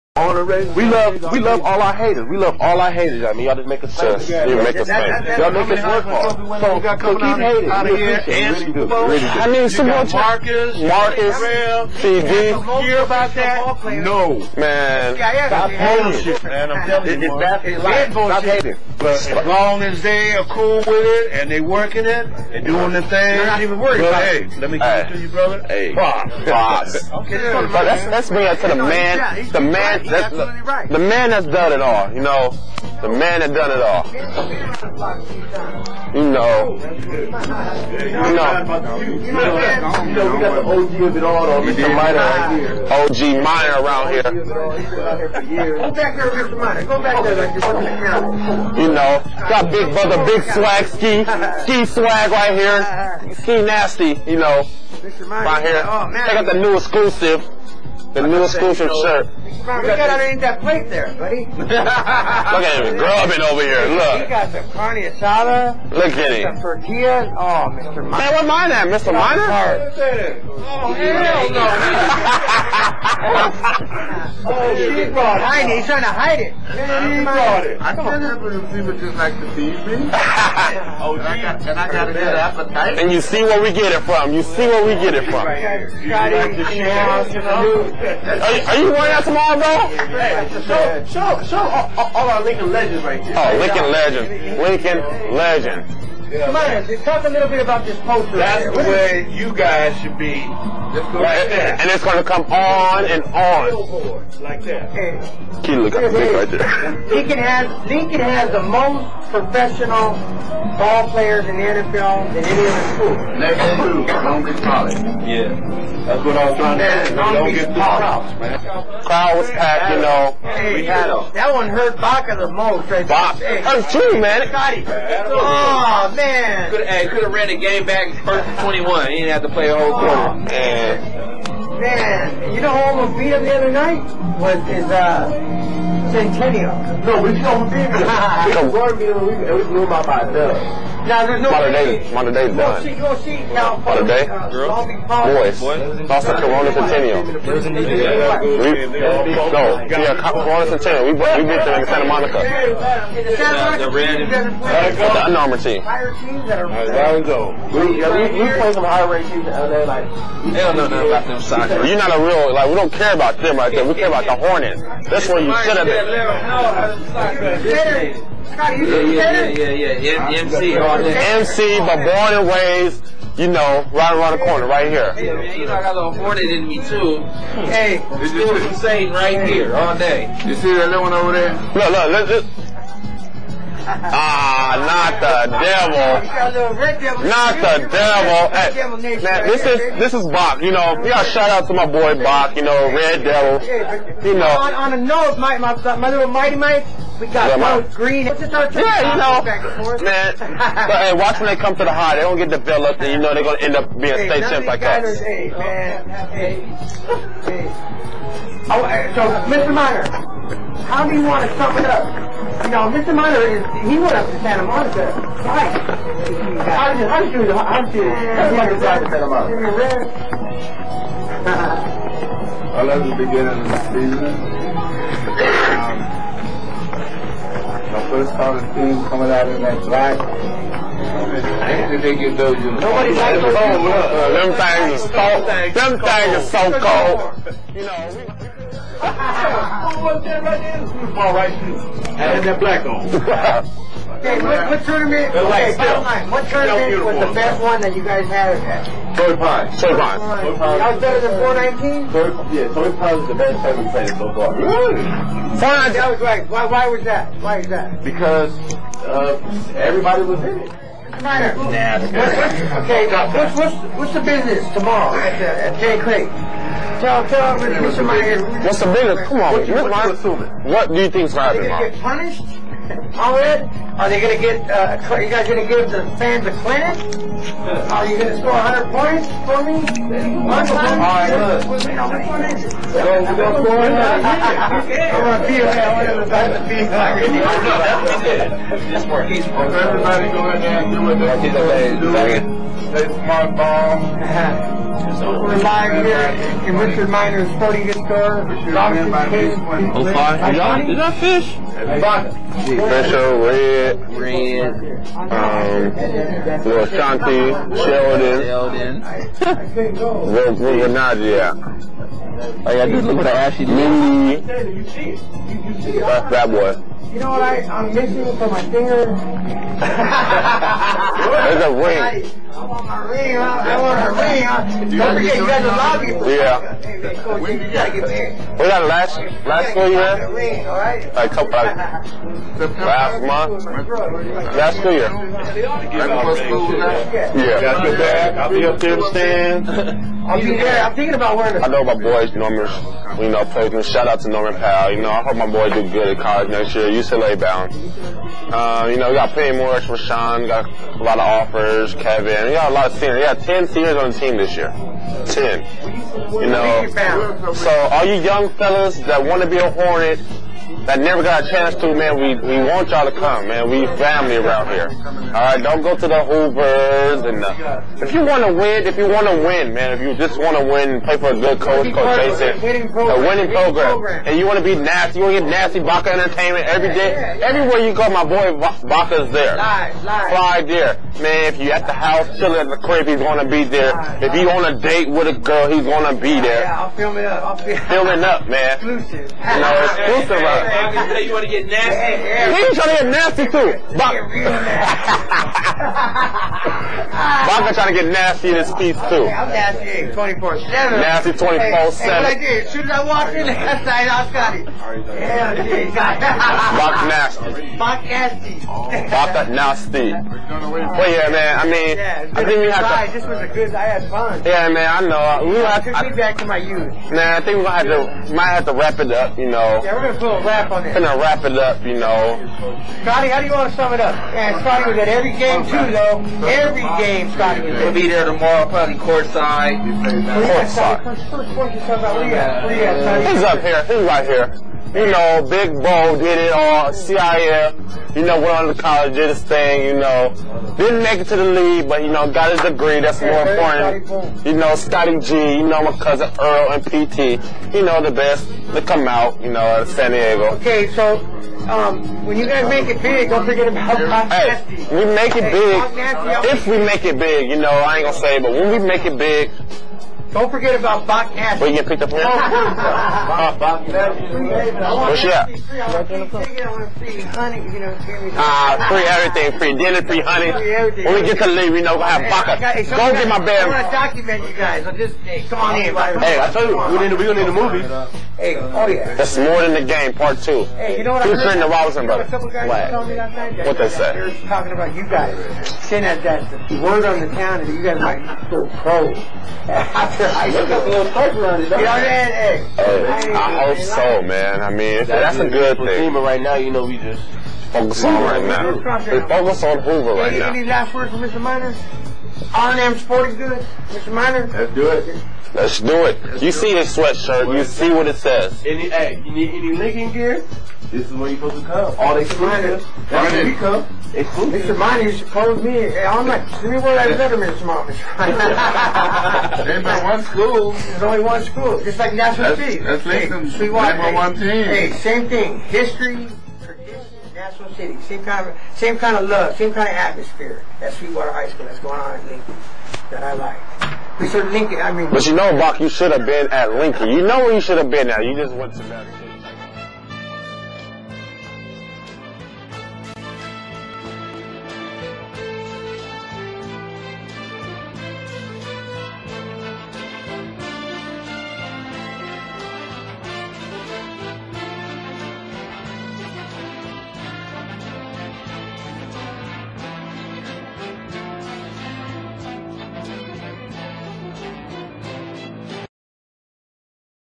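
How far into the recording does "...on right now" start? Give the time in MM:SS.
08:18.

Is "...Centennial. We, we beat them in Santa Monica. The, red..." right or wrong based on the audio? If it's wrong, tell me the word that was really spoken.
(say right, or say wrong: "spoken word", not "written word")
right.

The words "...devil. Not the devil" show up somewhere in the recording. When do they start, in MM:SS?
03:05.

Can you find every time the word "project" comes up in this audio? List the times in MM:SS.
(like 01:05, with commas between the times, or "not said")
not said.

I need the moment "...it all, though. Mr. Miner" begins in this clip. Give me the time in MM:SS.
00:41.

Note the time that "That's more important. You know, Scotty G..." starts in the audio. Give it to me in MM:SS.
07:22.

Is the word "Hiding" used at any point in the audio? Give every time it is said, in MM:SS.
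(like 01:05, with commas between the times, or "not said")
01:15.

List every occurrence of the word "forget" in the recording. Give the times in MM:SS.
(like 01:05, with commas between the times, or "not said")
05:25, 07:33, 07:40.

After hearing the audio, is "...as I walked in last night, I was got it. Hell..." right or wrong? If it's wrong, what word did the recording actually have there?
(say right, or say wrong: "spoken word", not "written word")
right.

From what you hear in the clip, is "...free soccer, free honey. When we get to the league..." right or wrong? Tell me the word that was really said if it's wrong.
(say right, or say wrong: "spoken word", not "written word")
wrong: "dinner", not "soccer".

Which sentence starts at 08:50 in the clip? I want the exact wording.
That's Sweetwater High School that's going on in Lincoln that I like.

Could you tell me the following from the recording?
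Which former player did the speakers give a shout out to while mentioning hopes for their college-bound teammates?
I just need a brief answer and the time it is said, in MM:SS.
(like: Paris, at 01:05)
Norman Powell, at 05:44.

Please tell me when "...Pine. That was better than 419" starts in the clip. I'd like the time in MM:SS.
04:09.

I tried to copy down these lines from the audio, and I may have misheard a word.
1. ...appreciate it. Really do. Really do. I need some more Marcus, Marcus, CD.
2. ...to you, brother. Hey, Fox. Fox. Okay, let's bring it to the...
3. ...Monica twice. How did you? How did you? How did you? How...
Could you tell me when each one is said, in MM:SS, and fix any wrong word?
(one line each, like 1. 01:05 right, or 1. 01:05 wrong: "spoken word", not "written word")
1. 00:07 right
2. 00:25 right
3. 03:34 right.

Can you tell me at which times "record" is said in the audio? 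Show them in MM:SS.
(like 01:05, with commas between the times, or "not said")
not said.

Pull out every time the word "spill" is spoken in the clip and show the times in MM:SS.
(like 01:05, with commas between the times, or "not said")
not said.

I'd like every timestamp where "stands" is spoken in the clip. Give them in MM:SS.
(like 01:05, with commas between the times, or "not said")
05:39.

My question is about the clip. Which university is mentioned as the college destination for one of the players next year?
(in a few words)
UCLA.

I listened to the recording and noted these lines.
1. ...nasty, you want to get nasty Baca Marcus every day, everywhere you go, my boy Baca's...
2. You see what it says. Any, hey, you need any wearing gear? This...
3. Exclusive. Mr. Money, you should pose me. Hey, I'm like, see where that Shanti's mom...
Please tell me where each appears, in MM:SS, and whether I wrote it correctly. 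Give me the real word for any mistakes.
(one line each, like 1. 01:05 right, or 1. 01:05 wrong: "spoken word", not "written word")
1. 06:14 wrong: "Entertainment", not "Marcus"
2. 08:27 wrong: "linking", not "wearing"
3. 08:34 wrong: "Letterman", not "Shanti".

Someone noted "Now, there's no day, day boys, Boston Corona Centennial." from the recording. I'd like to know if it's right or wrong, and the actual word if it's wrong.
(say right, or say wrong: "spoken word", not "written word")
right.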